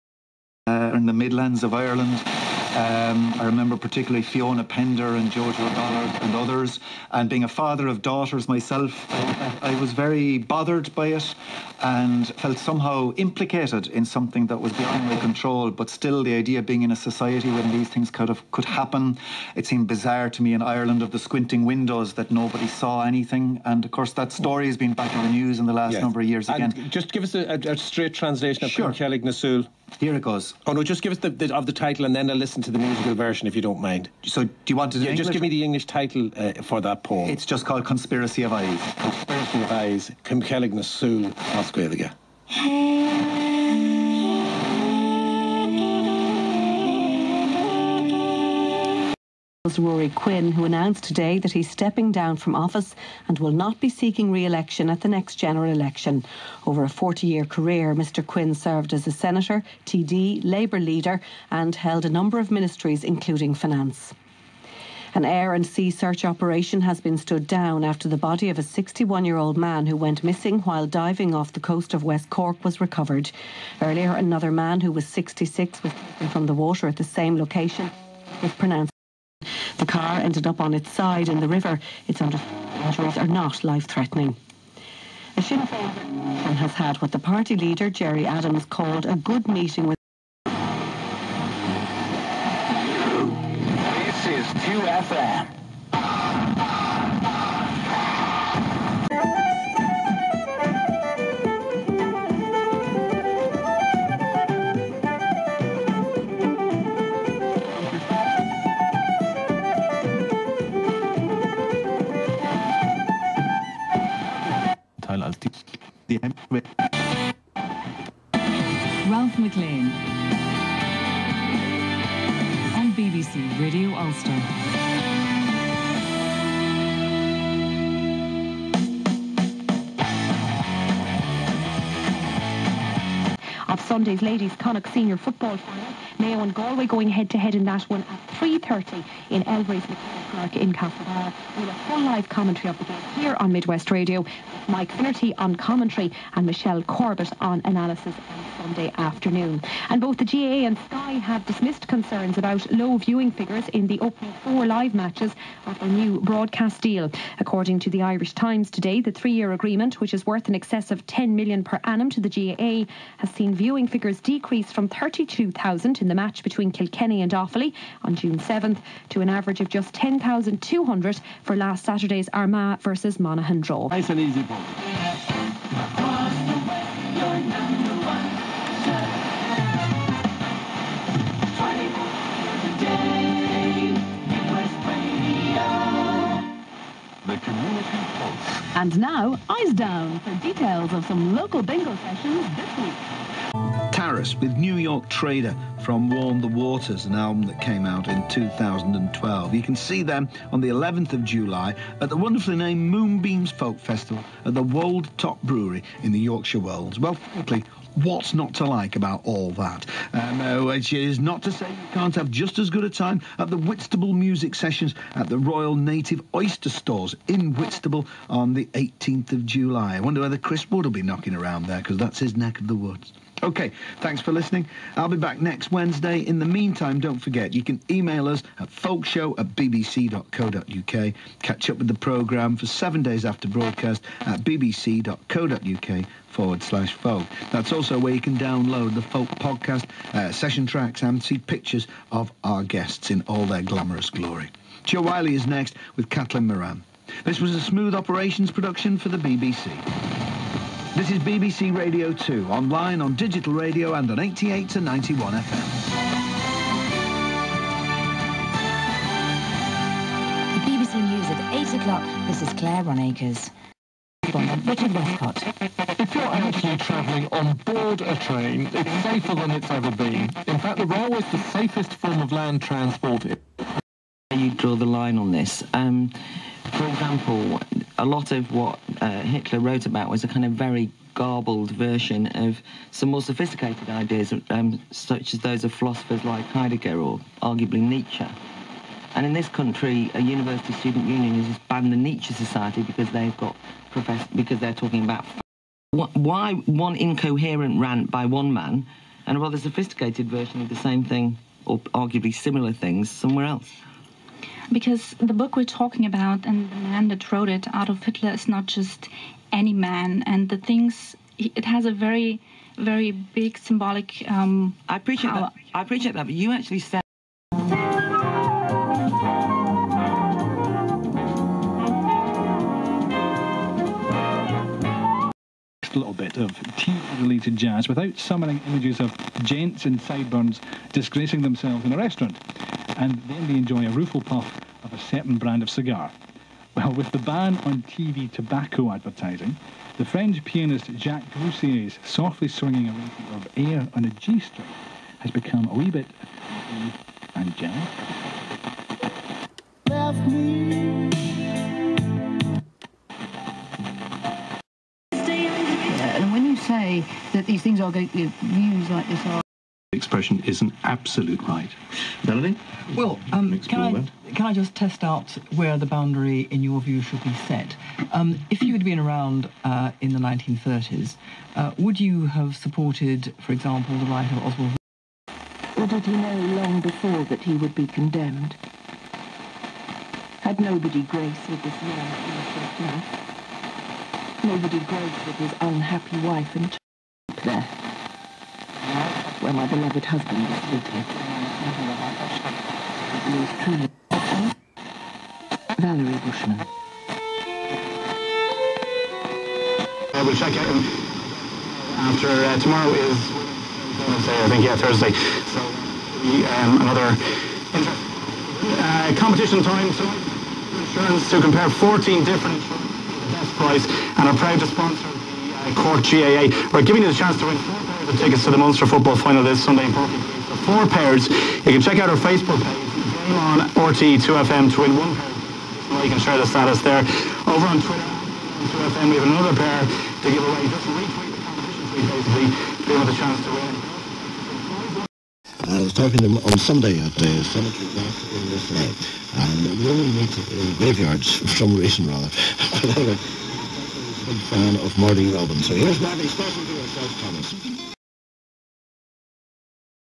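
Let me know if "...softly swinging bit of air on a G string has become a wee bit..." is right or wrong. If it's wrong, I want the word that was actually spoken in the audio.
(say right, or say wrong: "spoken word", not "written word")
right.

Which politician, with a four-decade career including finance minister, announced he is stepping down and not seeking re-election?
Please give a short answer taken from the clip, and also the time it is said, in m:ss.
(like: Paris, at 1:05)
Ruairi Quinn, at 0:49.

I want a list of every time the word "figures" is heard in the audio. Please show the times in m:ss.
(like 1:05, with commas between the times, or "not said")
2:33, 2:43.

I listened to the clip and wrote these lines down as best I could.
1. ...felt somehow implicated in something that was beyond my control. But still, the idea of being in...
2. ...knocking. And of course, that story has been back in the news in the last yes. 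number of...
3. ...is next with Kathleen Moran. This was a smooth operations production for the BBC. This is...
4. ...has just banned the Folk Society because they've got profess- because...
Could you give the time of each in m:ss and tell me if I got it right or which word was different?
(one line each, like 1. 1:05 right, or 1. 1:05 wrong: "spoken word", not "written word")
1. 0:12 right
2. 0:23 wrong: "anything", not "knocking"
3. 4:05 right
4. 4:51 wrong: "Nietzsche", not "Folk".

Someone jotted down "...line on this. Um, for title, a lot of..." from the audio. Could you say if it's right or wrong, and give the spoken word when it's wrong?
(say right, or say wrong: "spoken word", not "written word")
wrong: "example", not "title".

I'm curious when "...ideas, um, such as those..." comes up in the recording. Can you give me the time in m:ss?
4:43.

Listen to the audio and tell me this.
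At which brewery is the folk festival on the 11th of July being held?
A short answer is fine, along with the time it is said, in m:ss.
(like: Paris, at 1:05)
Wold Top Brewery, at 3:24.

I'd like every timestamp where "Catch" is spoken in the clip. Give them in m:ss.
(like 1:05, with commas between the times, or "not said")
3:51.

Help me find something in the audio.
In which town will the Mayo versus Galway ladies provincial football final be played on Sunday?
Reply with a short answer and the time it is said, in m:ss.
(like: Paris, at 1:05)
Castlebar, at 2:20.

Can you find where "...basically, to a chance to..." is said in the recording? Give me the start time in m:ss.
7:12.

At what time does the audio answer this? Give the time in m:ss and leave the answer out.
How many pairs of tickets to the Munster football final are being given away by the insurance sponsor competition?
7:00.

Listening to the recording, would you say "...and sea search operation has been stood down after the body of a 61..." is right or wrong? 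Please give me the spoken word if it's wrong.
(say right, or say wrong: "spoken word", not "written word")
right.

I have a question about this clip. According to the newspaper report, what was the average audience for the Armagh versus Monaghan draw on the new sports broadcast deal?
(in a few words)
10,200.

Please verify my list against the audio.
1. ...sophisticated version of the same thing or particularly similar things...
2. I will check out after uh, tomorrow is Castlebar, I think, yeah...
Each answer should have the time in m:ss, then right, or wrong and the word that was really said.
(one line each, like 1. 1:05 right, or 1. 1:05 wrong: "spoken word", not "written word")
1. 4:59 wrong: "arguably", not "particularly"
2. 6:40 wrong: "Thursday", not "Castlebar".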